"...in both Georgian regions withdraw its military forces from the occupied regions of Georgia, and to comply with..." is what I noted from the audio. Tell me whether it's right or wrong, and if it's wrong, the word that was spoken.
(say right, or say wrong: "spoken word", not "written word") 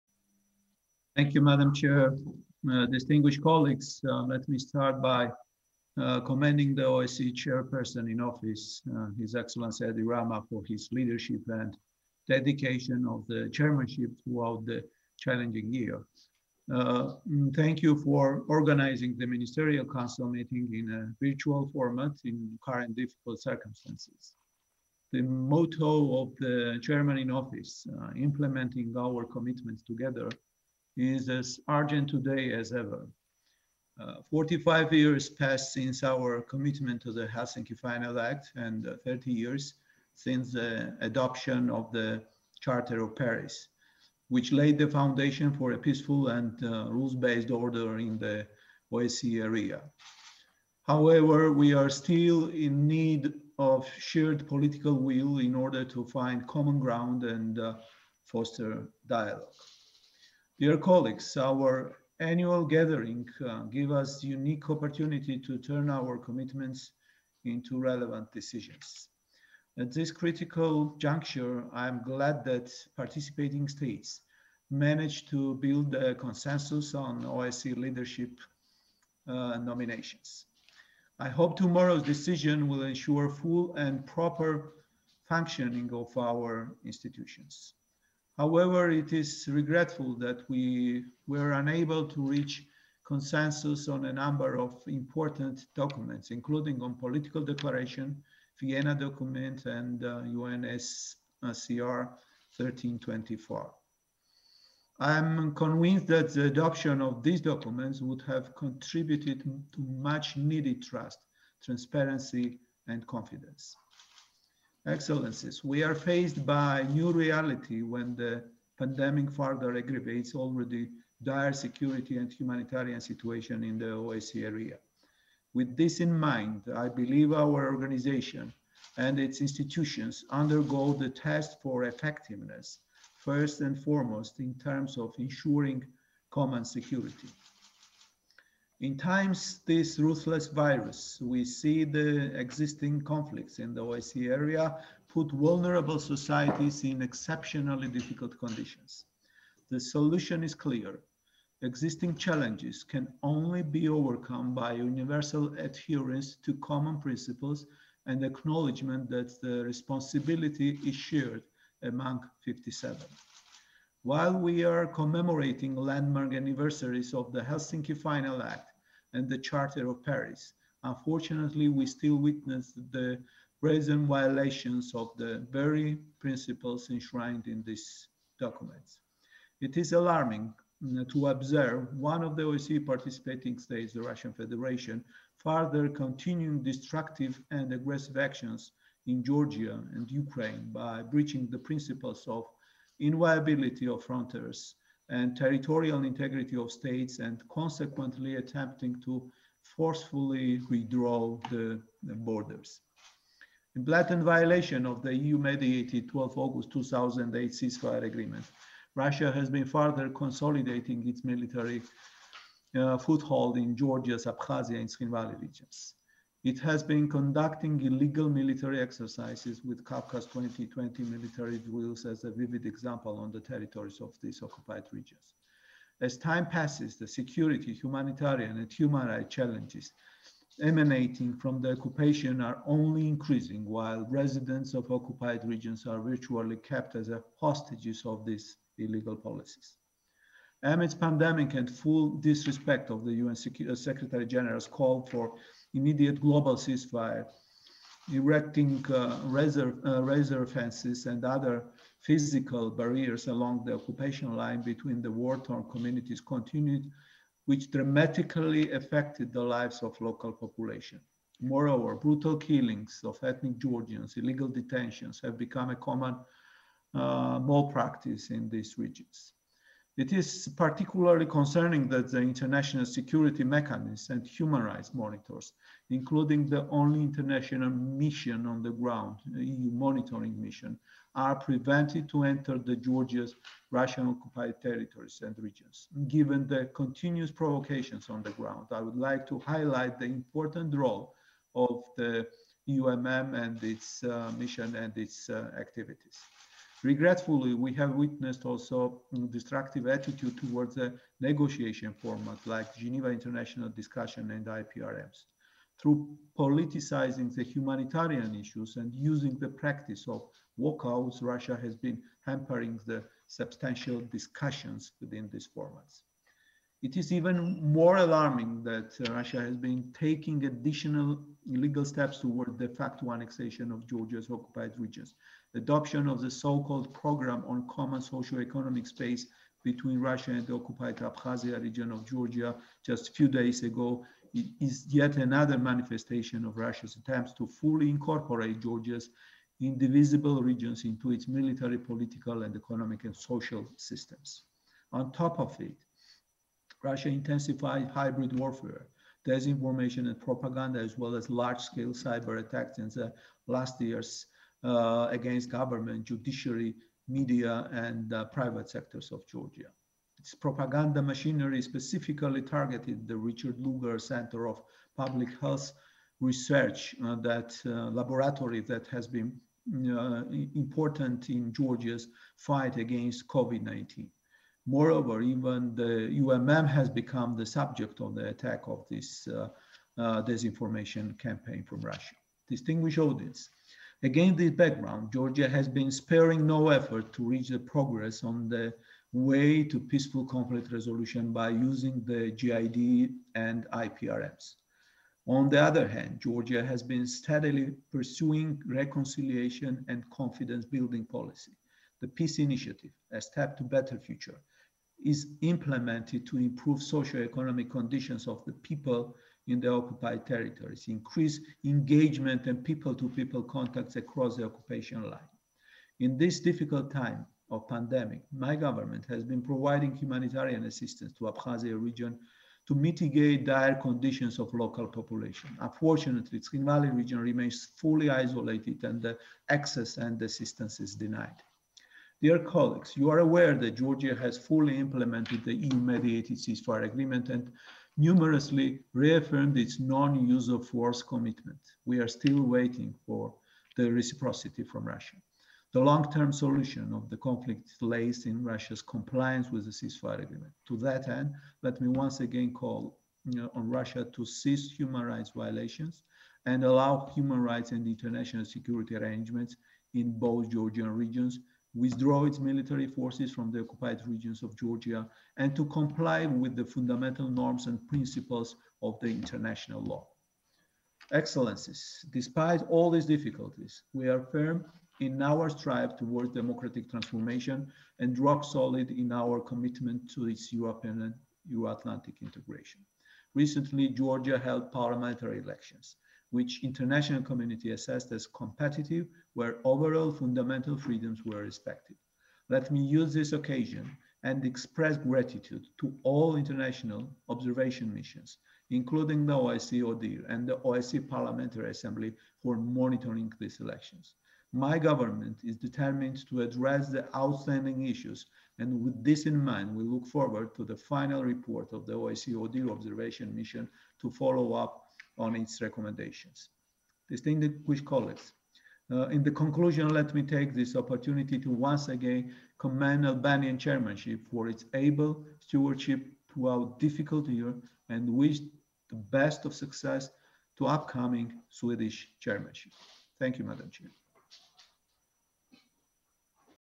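right.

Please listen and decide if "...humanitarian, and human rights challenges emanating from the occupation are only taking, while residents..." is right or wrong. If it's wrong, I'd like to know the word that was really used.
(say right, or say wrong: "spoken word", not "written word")
wrong: "increasing", not "taking".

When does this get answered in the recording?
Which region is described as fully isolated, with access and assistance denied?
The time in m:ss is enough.
7:06.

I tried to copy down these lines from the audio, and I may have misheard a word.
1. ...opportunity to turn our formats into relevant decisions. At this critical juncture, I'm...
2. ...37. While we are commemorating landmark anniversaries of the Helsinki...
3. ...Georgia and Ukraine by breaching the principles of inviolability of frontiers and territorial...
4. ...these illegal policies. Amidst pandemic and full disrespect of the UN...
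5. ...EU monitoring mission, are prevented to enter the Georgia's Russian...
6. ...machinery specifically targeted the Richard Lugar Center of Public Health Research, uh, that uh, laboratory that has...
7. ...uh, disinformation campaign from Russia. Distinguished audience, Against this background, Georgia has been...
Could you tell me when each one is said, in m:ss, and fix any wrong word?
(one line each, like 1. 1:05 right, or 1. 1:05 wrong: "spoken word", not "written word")
1. 1:04 wrong: "commitments", not "formats"
2. 2:42 wrong: "57", not "37"
3. 3:09 right
4. 3:58 right
5. 4:39 right
6. 6:01 right
7. 6:19 right.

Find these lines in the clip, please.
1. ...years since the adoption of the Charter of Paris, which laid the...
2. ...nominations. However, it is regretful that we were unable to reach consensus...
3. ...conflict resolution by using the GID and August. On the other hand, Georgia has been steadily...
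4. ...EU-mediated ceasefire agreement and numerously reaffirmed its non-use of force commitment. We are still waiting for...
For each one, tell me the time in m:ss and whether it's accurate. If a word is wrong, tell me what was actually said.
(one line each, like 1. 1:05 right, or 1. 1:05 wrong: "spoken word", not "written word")
1. 0:39 right
2. 1:26 wrong: "institutions", not "nominations"
3. 6:30 wrong: "IPRMs", not "August"
4. 7:15 right.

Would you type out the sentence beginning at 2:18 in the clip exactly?
In times this ruthless virus, we see the existing conflicts in the OSCE area put vulnerable societies in exceptionally difficult conditions.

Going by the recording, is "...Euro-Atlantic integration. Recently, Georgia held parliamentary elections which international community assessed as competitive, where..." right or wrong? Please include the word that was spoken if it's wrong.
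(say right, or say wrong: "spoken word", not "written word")
right.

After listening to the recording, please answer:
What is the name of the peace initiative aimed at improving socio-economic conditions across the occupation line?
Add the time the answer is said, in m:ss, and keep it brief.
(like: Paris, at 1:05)
A step to better future, at 6:43.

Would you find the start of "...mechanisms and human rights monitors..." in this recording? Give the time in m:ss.
4:33.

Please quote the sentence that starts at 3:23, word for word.
in blatant violation of the EU-mediated 12 August 2008 ceasefire agreement.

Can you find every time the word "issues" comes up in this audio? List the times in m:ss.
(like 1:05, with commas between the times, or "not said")
5:08, 8:27.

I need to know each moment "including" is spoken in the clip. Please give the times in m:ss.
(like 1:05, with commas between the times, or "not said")
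1:36, 4:35, 8:18.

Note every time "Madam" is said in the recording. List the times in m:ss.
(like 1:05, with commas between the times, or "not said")
0:01, 8:53.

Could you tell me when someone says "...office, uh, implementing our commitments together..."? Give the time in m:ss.
0:27.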